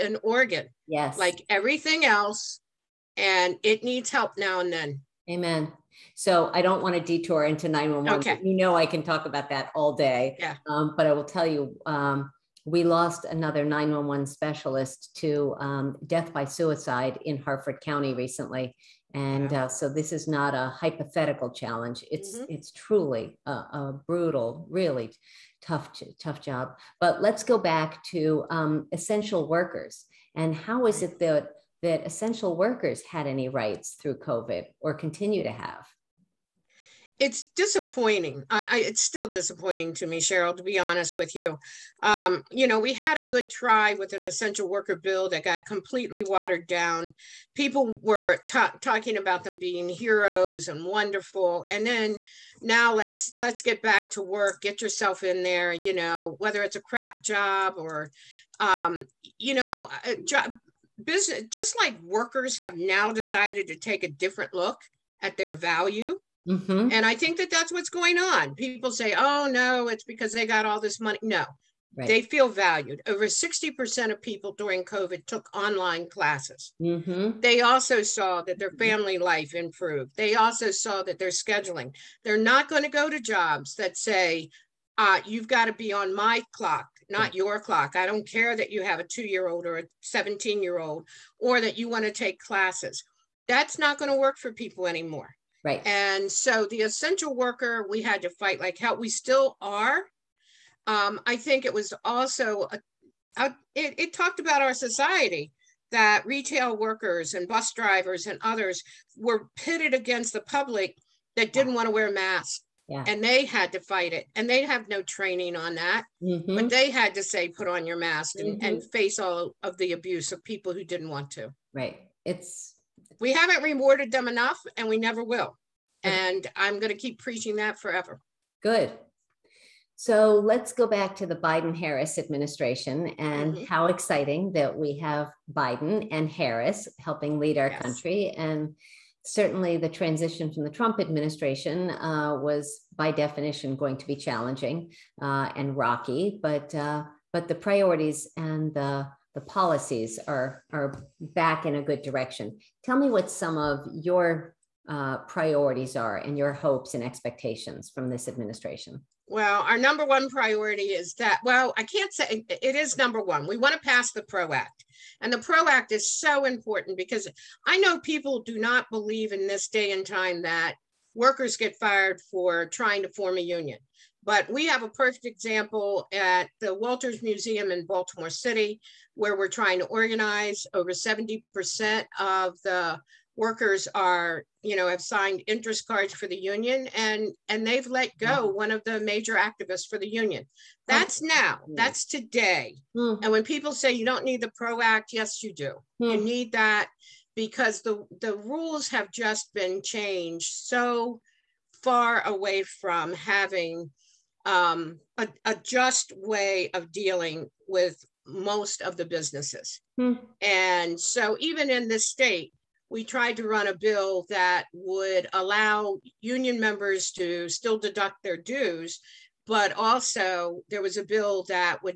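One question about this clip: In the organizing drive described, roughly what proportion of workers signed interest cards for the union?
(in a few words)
Over 70%.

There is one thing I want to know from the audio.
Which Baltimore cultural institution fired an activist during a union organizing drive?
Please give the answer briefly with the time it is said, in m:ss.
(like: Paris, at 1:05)
Walters Museum, at 2:56.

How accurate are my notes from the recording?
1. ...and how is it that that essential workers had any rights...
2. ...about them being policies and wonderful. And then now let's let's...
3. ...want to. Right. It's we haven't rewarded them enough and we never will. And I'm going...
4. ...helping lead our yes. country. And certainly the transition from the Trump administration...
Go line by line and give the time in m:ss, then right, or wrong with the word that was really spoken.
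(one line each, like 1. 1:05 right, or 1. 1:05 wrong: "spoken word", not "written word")
1. 0:30 right
2. 0:49 wrong: "heroes", not "policies"
3. 2:01 right
4. 2:17 right.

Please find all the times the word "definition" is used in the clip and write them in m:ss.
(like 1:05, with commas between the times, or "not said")
2:23.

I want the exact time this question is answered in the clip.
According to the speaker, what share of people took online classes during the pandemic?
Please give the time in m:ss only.
1:13.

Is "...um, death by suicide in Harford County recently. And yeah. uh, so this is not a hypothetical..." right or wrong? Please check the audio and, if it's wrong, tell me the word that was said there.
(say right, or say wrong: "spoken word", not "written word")
right.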